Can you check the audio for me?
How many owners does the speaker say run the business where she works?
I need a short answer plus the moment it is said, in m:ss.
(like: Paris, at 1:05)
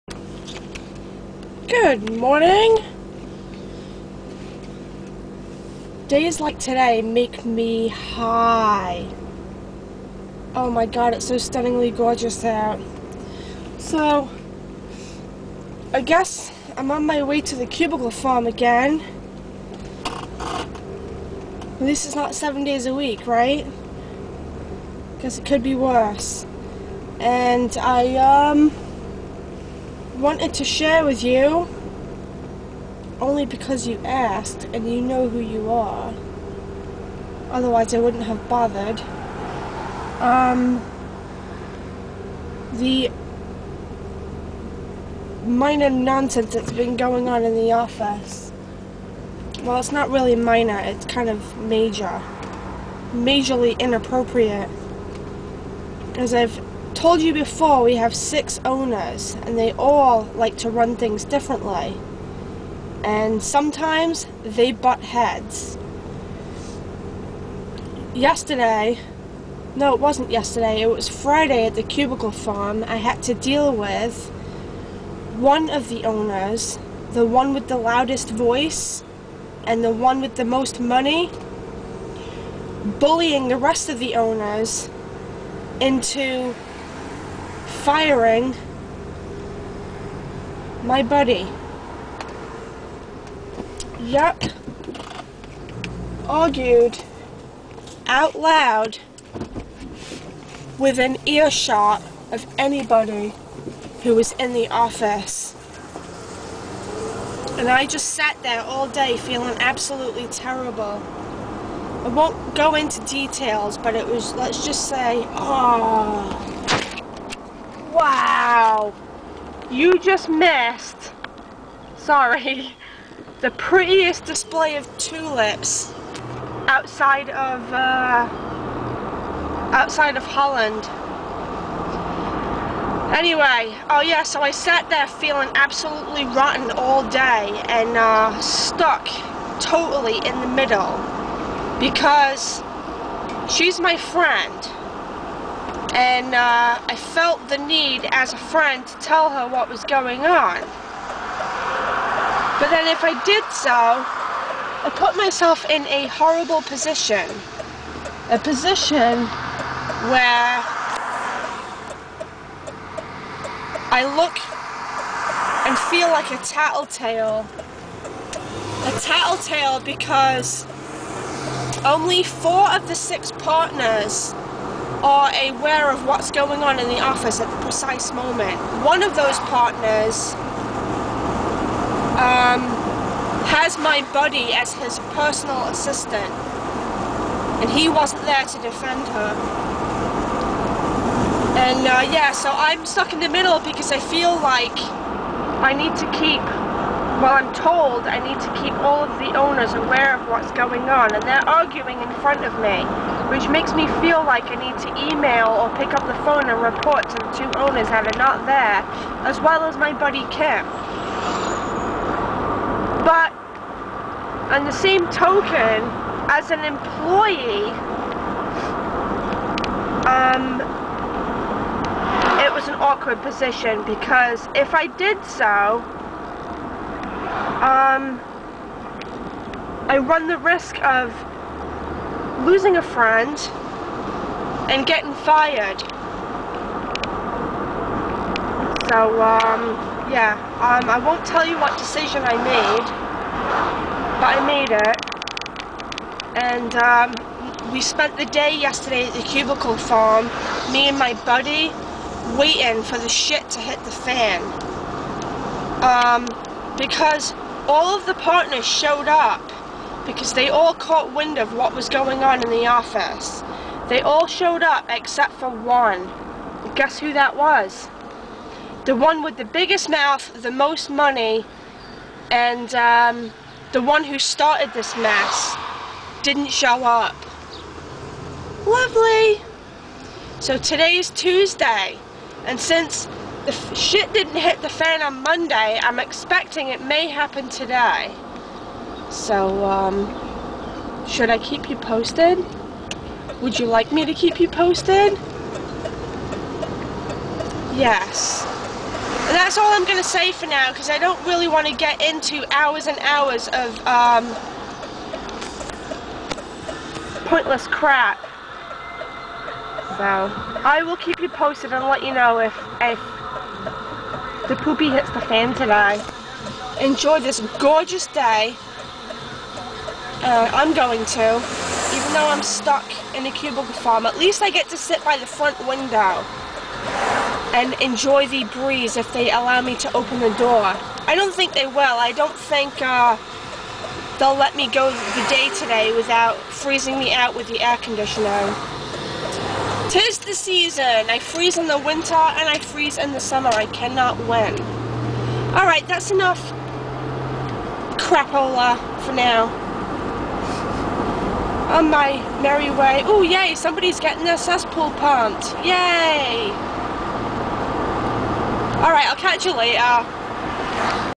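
6, at 0:58.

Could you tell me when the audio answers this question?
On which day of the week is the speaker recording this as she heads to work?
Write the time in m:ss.
4:41.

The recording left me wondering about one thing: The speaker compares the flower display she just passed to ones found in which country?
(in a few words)
Holland.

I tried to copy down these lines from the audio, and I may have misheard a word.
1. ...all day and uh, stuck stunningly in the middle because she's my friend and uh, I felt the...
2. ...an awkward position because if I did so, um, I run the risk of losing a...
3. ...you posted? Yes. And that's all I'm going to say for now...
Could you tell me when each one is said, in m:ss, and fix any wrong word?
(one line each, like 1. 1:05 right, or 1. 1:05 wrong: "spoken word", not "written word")
1. 2:16 wrong: "totally", not "stunningly"
2. 3:42 right
3. 4:54 right.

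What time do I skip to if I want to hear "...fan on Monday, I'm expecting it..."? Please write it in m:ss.
4:44.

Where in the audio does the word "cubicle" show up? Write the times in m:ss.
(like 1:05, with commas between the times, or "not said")
0:17, 1:11, 4:09, 5:23.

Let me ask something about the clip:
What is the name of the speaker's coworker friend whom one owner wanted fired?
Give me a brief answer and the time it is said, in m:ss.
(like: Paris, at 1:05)
Kim, at 3:30.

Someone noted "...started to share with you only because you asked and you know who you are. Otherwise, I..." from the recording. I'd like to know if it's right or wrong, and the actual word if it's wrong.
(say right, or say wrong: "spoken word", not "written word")
wrong: "wanted", not "started".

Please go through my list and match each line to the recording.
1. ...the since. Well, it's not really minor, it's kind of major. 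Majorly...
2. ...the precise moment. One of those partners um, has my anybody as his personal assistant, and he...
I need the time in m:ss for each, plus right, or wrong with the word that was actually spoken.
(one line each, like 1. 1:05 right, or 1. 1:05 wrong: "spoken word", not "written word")
1. 0:47 wrong: "office", not "since"
2. 2:57 wrong: "buddy", not "anybody".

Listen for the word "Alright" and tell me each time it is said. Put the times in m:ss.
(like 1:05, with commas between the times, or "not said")
5:45, 5:58.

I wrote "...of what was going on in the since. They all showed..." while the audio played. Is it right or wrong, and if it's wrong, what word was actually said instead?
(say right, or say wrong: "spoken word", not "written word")
wrong: "office", not "since".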